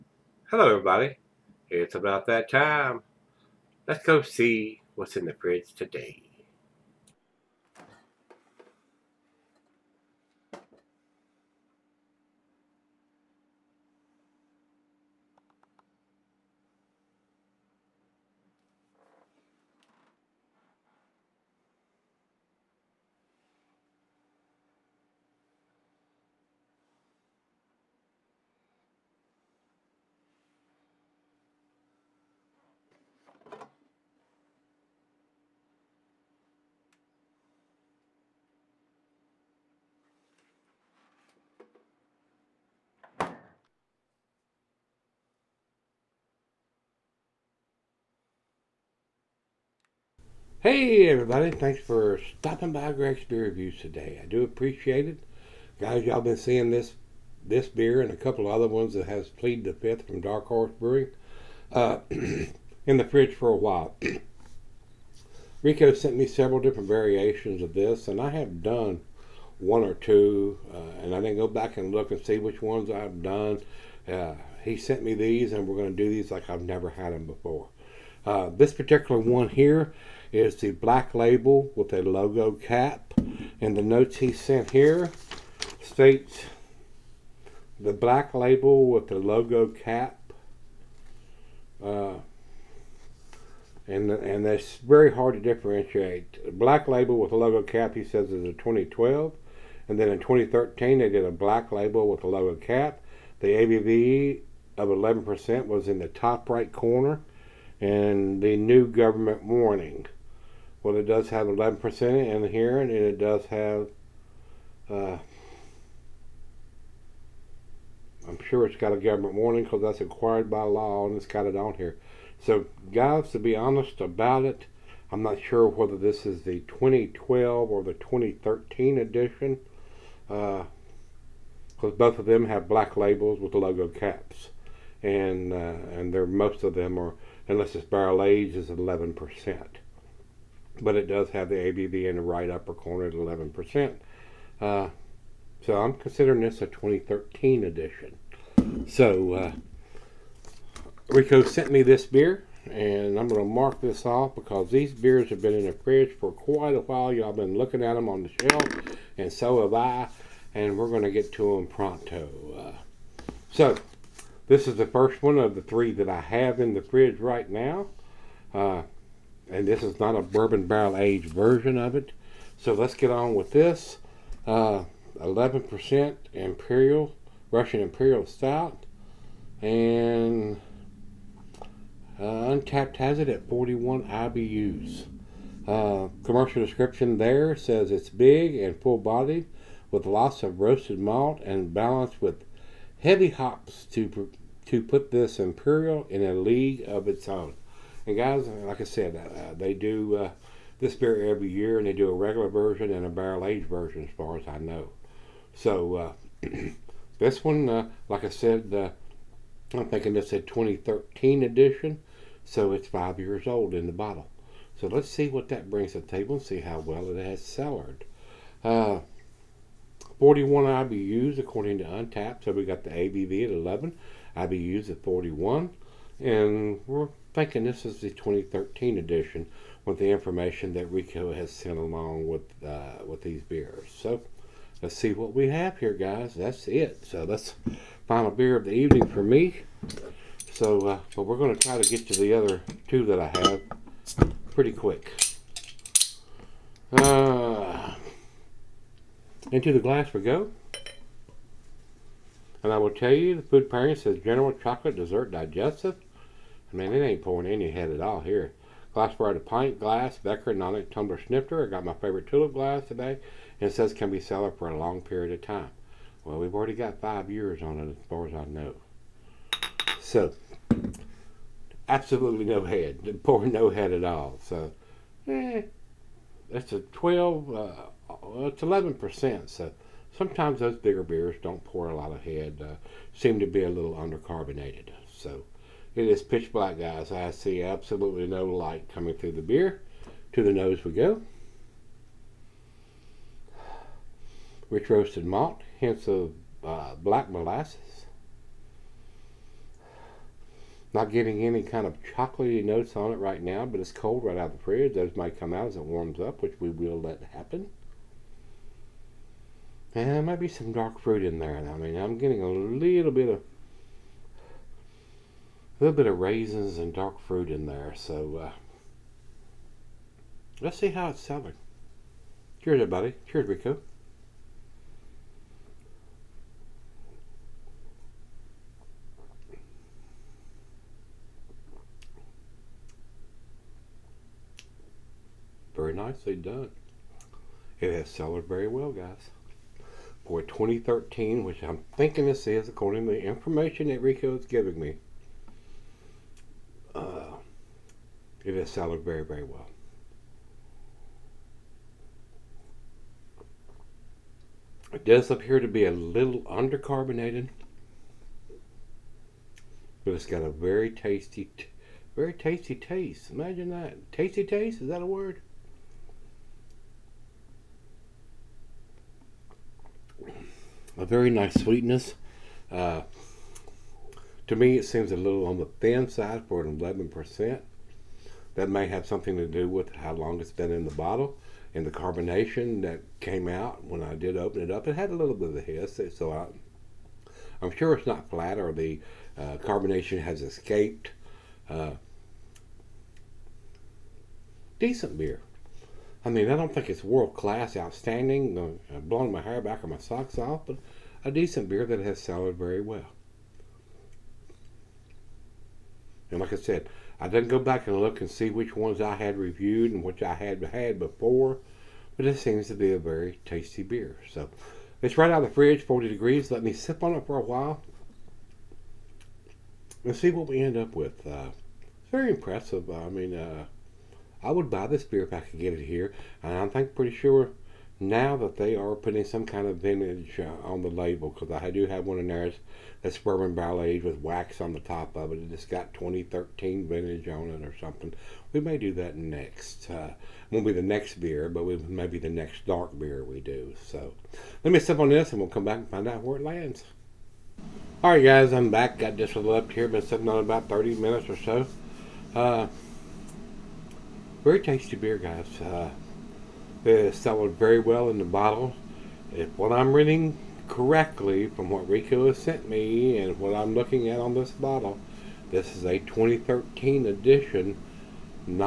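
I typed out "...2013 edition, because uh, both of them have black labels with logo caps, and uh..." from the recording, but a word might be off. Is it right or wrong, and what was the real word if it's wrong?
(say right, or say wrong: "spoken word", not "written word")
right.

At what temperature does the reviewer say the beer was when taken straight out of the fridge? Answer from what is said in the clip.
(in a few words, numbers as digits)
40 degrees.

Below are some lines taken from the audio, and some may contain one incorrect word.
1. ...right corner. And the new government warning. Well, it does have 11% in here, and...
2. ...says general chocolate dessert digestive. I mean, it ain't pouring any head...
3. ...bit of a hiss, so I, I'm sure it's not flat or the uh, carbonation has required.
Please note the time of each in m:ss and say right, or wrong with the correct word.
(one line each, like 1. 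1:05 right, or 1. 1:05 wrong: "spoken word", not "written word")
1. 1:46 right
2. 4:13 right
3. 6:25 wrong: "escaped", not "required".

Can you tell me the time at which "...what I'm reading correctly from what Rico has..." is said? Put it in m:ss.
7:39.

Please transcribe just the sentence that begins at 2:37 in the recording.
Y'all been looking at them on the shelf, and so have I, and we're going to get to them pronto.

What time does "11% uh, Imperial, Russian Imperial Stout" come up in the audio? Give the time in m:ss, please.
2:54.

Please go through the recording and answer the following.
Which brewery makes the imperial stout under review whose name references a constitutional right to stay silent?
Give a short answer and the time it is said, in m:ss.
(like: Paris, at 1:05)
Dark Horse Brewing, at 1:00.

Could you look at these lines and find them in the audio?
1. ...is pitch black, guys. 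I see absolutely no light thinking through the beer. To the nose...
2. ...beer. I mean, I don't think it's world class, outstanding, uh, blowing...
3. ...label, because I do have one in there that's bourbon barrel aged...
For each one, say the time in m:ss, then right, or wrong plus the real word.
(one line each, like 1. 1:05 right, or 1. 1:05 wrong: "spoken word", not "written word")
1. 4:46 wrong: "coming", not "thinking"
2. 6:35 right
3. 7:10 right.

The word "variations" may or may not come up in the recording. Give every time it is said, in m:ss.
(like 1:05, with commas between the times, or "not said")
1:06.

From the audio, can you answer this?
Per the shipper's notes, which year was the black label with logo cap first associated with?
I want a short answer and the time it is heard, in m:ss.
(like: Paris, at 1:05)
2012, at 1:38.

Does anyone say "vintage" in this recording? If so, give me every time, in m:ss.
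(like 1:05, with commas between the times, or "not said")
7:09, 7:16.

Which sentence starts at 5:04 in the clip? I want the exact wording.
Those might come out as it warms up, which we will let happen.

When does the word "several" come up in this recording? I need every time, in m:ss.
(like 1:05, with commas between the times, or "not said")
1:06.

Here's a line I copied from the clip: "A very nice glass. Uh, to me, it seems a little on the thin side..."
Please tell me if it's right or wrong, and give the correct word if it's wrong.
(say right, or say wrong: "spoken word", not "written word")
wrong: "sweetness", not "glass".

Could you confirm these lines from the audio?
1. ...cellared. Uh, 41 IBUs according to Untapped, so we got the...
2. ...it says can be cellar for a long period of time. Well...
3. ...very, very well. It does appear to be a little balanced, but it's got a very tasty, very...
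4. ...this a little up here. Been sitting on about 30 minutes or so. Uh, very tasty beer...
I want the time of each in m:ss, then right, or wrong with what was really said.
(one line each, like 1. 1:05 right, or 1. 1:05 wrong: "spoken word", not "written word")
1. 3:37 right
2. 4:23 right
3. 5:49 wrong: "undercarbonated", not "balanced"
4. 7:29 right.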